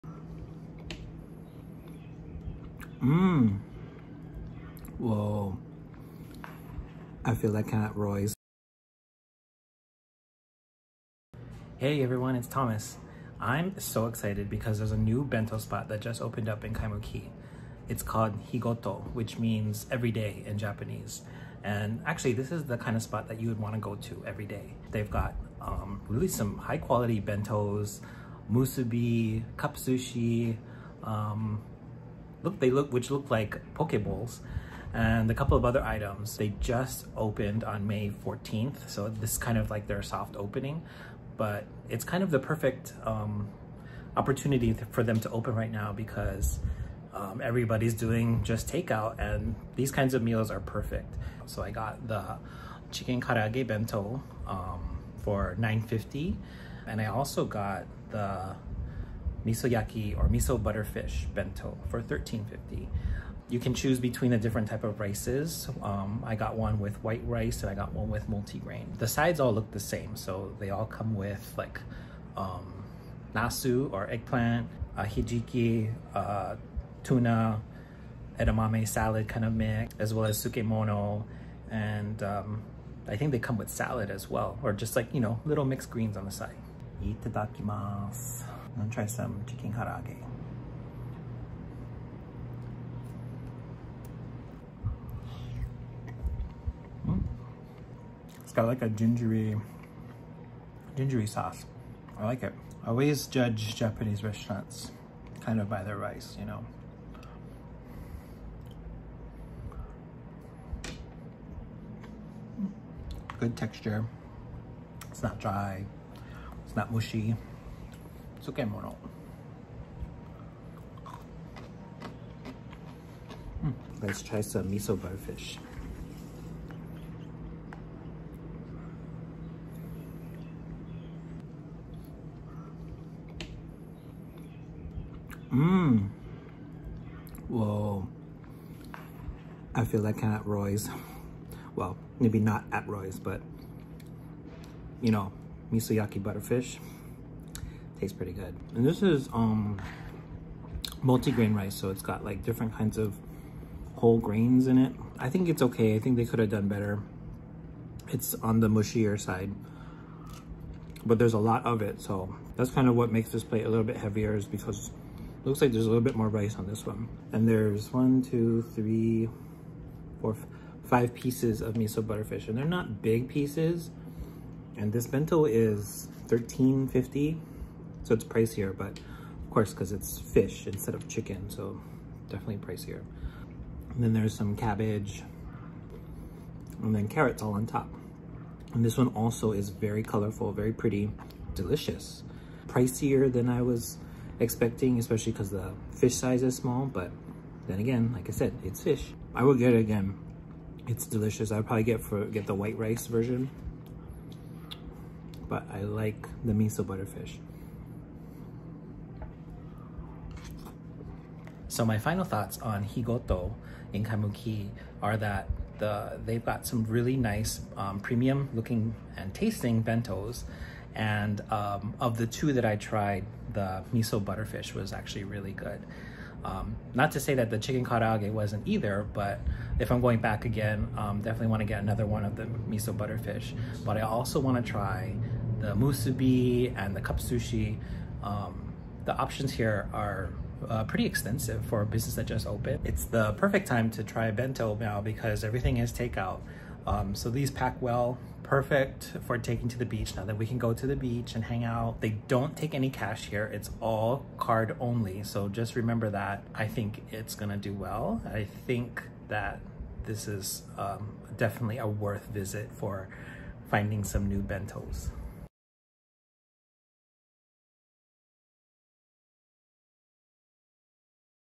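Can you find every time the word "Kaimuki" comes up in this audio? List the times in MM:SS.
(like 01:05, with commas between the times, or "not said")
00:16, 03:34.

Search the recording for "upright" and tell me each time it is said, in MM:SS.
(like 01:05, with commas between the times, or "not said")
not said.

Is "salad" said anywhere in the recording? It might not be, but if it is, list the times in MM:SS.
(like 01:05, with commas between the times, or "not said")
01:18, 01:23.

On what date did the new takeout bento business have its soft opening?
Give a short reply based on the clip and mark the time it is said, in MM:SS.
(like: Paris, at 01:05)
May 14th, at 00:37.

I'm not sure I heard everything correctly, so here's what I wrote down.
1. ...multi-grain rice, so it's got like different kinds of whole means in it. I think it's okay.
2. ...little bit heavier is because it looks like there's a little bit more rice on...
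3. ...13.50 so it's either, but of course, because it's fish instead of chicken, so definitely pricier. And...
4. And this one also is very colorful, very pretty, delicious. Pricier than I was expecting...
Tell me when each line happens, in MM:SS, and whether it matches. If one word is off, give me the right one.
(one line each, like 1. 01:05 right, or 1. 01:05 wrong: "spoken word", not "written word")
1. 02:31 wrong: "grains", not "means"
2. 02:43 right
3. 02:56 wrong: "pricier", not "either"
4. 03:08 right.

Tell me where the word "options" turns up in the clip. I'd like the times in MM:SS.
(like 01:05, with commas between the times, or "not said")
03:59.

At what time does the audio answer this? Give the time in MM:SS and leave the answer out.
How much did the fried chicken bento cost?
00:55.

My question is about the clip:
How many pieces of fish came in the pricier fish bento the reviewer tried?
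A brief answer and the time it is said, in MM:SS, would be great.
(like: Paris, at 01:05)
5, at 02:50.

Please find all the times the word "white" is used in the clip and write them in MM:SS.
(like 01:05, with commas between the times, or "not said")
01:07, 03:22.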